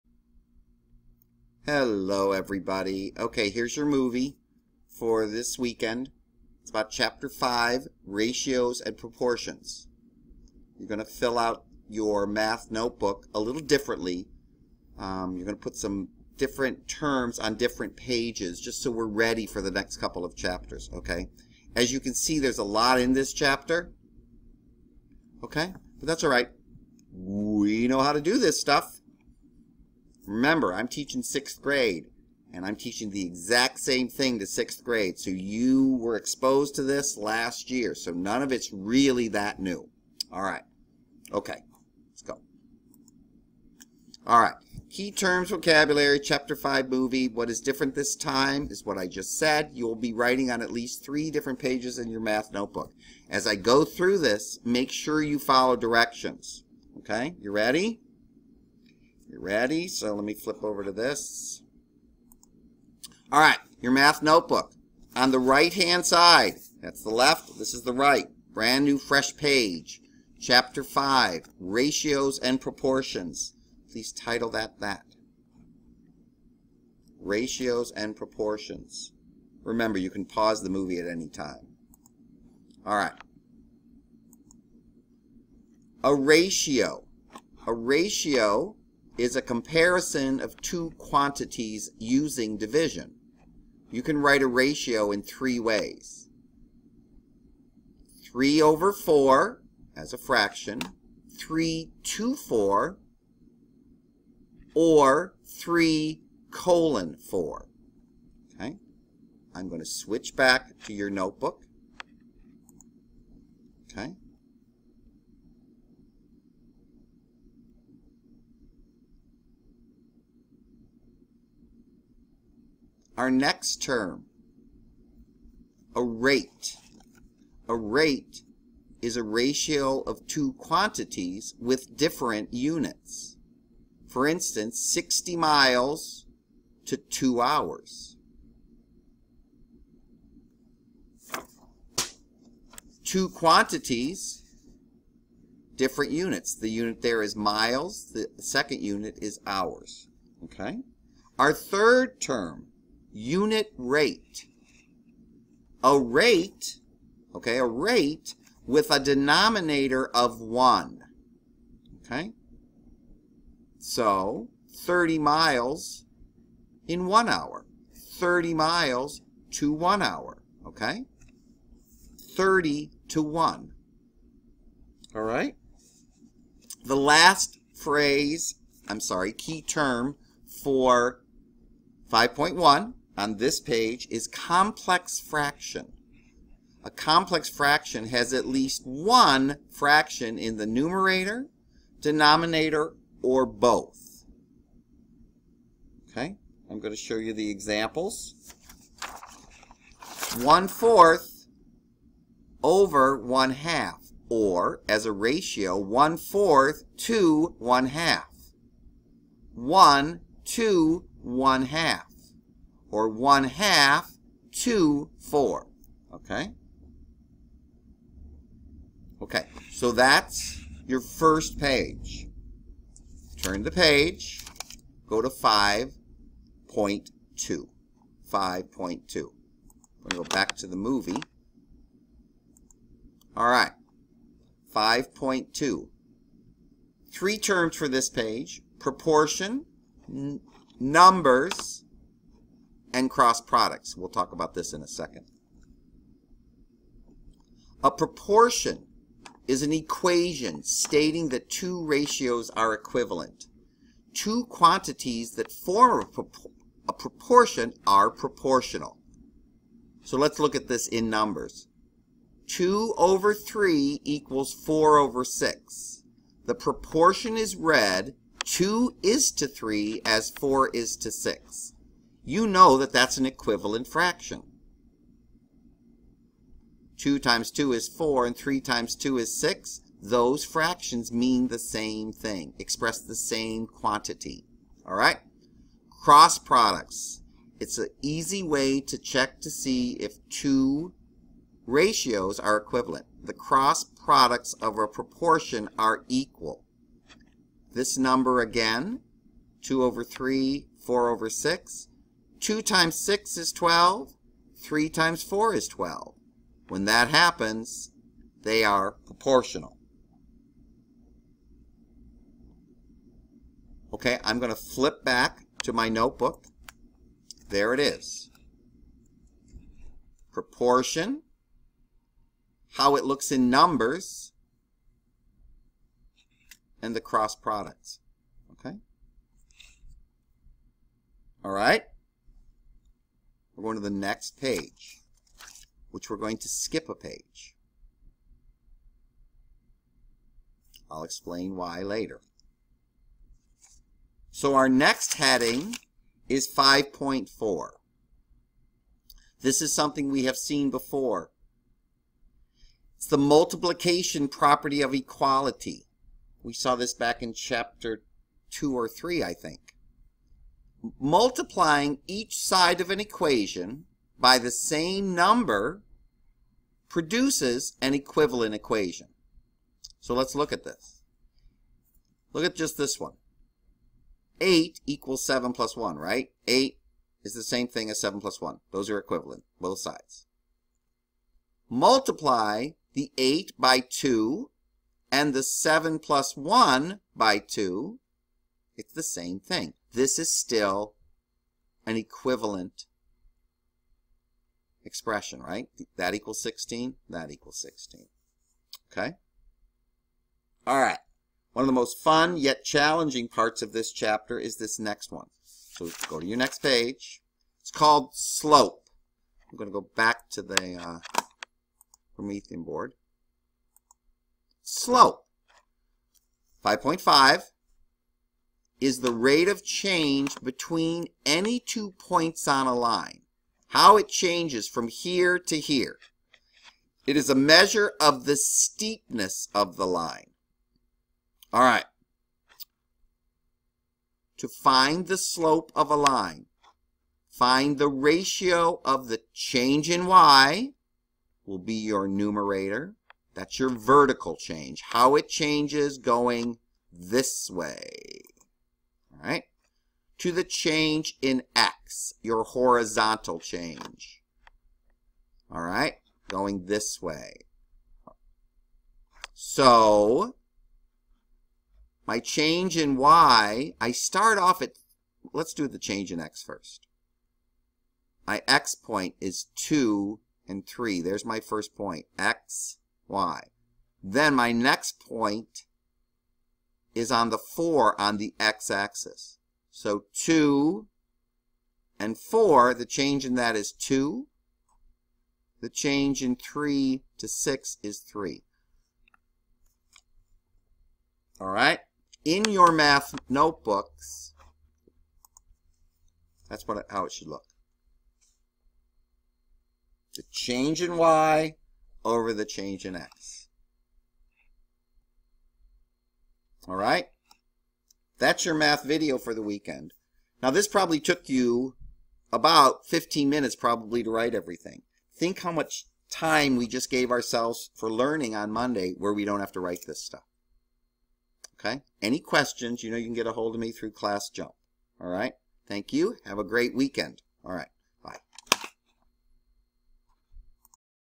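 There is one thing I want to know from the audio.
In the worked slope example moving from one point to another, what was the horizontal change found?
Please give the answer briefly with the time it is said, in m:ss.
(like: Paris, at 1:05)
2, at 8:02.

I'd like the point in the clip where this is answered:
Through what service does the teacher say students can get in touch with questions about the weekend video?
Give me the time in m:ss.
8:43.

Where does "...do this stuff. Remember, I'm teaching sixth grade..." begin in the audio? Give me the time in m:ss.
0:28.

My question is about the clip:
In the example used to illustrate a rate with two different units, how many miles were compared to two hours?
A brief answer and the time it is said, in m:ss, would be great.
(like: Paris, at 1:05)
60, at 2:14.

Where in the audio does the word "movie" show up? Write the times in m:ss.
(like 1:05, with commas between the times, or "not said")
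0:03, 0:46, 1:20, 3:50.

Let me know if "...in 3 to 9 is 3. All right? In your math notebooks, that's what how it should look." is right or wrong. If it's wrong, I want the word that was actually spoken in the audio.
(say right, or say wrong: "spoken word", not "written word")
wrong: "6", not "9".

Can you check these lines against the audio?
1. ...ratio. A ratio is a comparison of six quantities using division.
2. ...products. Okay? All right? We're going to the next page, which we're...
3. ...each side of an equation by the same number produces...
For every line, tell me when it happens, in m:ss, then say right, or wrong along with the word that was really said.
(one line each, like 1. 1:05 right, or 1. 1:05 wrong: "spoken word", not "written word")
1. 1:26 wrong: "two", not "six"
2. 5:27 right
3. 6:02 right.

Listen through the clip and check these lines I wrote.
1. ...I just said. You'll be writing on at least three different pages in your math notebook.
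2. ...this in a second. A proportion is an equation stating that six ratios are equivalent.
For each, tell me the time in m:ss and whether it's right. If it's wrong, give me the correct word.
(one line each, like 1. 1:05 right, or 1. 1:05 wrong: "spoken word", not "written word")
1. 0:48 right
2. 4:04 wrong: "two", not "six".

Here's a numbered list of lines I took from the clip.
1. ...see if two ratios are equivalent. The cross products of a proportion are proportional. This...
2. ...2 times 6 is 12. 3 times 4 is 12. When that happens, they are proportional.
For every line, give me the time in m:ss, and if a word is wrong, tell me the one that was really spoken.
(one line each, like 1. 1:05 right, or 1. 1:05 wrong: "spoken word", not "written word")
1. 4:49 wrong: "equal", not "proportional"
2. 5:02 right.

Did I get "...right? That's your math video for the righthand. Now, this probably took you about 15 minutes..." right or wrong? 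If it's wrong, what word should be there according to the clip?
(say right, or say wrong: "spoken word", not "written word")
wrong: "weekend", not "righthand".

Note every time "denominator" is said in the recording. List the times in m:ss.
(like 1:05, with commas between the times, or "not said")
2:38, 3:11.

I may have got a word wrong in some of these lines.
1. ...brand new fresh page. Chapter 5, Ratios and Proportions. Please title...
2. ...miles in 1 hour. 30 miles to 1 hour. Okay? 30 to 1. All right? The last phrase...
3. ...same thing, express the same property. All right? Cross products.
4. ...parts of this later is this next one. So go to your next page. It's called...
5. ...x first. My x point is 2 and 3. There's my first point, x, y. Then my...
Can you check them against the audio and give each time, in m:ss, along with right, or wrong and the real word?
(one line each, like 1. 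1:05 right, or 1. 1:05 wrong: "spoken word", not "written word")
1. 1:08 right
2. 2:45 right
3. 4:41 wrong: "quantity", not "property"
4. 6:43 wrong: "chapter", not "later"
5. 7:46 right.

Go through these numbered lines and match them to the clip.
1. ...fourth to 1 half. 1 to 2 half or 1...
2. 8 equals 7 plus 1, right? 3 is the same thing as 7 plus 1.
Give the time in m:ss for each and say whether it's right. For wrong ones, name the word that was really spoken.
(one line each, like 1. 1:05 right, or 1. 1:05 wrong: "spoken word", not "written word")
1. 3:26 wrong: "1", not "2"
2. 6:14 wrong: "8", not "3".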